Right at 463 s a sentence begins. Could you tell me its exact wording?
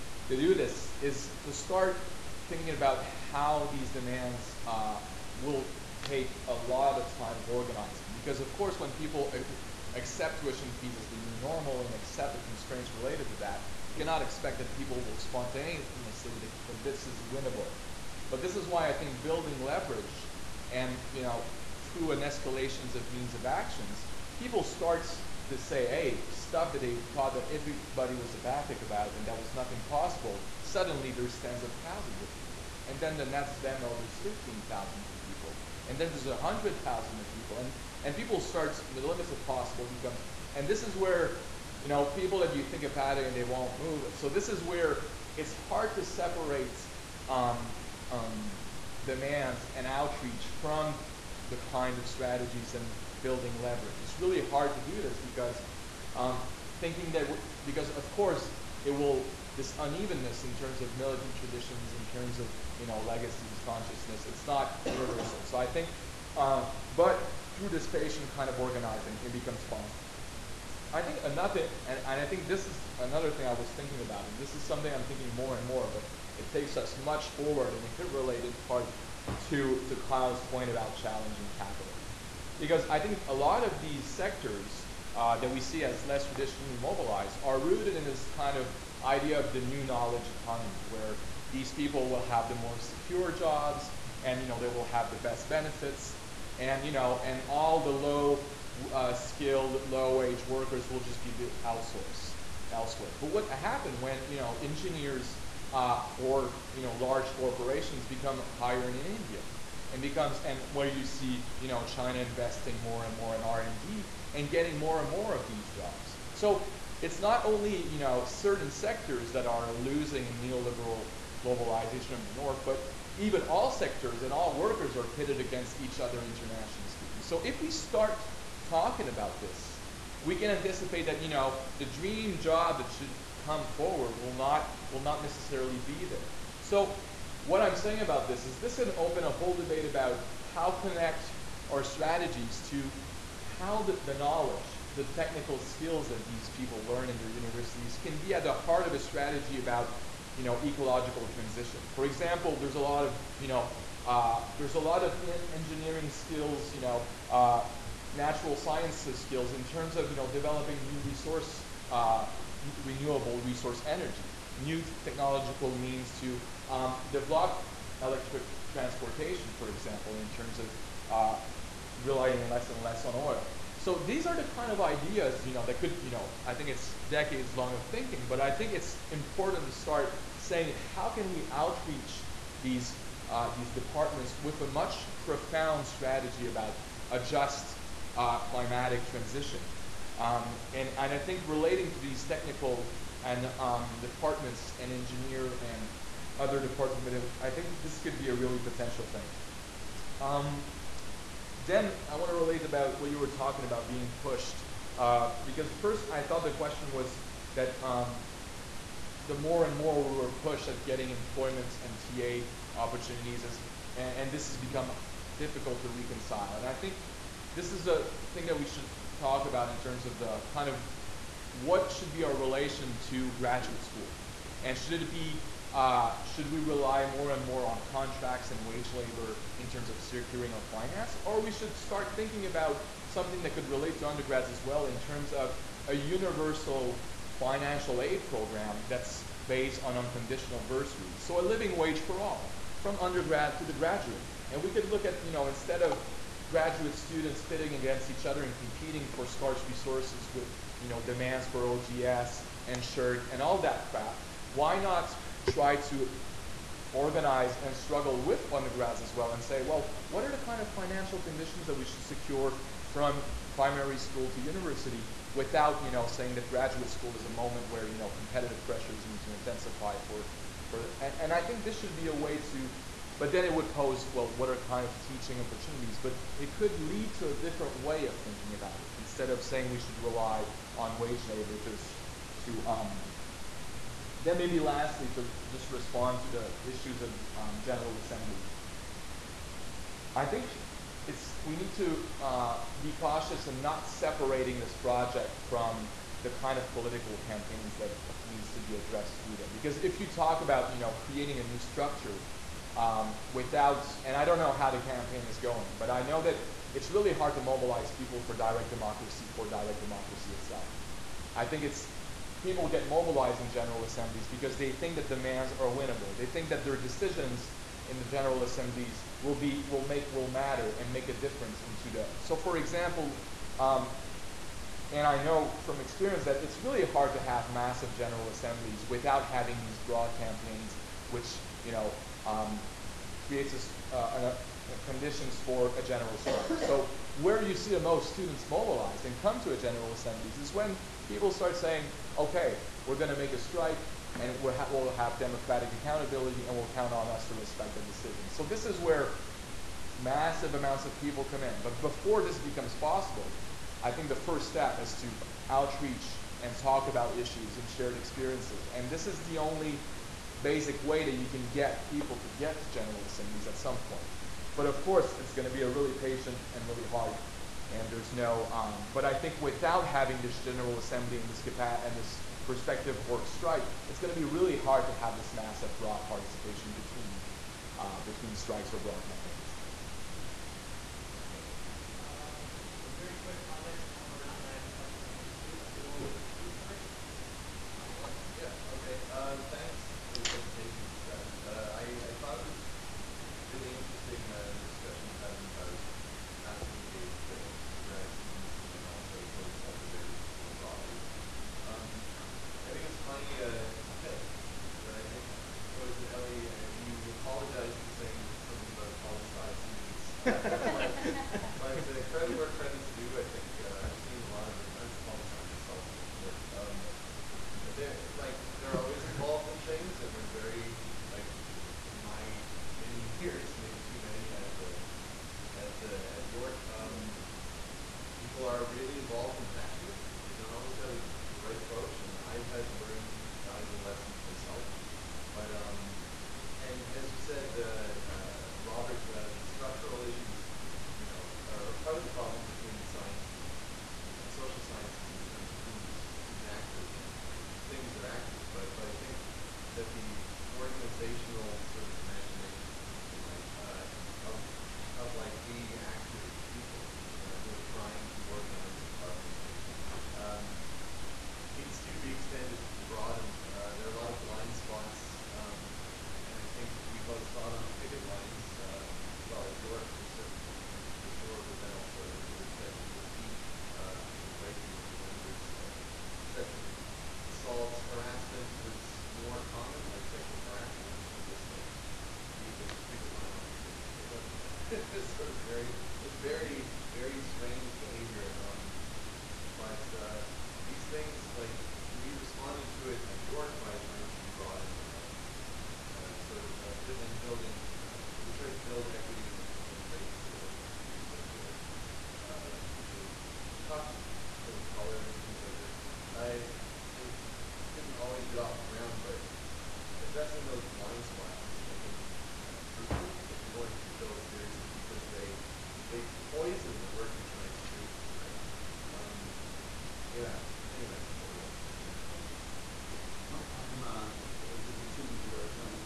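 Uh, there are a lot of blind spots, um, and I think we both saw it on the picket lines.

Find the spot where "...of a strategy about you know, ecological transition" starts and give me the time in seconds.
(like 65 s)
148 s.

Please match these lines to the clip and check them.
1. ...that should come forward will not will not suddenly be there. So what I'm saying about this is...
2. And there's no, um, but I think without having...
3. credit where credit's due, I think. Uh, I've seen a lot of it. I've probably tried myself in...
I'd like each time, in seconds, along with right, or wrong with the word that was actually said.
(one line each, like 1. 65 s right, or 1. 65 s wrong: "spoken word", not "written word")
1. 132 s wrong: "necessarily", not "suddenly"
2. 367 s right
3. 412 s wrong: "signed", not "tried".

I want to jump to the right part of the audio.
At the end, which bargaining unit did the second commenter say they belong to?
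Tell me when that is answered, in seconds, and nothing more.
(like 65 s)
524 s.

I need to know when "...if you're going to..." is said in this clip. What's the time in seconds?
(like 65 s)
513 s.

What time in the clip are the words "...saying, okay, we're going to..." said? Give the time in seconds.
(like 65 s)
341 s.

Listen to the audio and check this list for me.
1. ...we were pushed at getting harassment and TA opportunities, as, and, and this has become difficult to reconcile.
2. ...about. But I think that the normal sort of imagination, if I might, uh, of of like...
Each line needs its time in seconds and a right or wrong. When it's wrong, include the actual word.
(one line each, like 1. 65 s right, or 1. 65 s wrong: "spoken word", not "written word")
1. 210 s wrong: "employment", not "harassment"
2. 448 s wrong: "organizational", not "normal".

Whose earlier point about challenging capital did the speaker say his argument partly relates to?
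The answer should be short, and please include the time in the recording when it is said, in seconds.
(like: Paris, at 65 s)
Kyle, at 80 s.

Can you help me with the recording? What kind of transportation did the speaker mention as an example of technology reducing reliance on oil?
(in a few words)
electric transportation.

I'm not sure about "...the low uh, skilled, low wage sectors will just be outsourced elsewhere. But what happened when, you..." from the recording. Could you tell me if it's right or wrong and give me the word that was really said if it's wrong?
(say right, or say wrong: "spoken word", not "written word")
wrong: "workers", not "sectors".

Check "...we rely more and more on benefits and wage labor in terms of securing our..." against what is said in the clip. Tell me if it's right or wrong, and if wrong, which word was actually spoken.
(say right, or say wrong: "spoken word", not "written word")
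wrong: "contracts", not "benefits".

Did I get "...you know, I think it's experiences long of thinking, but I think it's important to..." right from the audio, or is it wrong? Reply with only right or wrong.
wrong.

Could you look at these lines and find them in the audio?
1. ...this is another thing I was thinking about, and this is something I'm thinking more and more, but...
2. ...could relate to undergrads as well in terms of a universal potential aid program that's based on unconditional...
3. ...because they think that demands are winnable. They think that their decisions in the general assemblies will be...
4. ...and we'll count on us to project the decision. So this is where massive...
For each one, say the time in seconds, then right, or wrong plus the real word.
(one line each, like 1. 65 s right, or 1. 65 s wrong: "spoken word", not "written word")
1. 72 s right
2. 233 s wrong: "financial", not "potential"
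3. 314 s right
4. 346 s wrong: "respect", not "project".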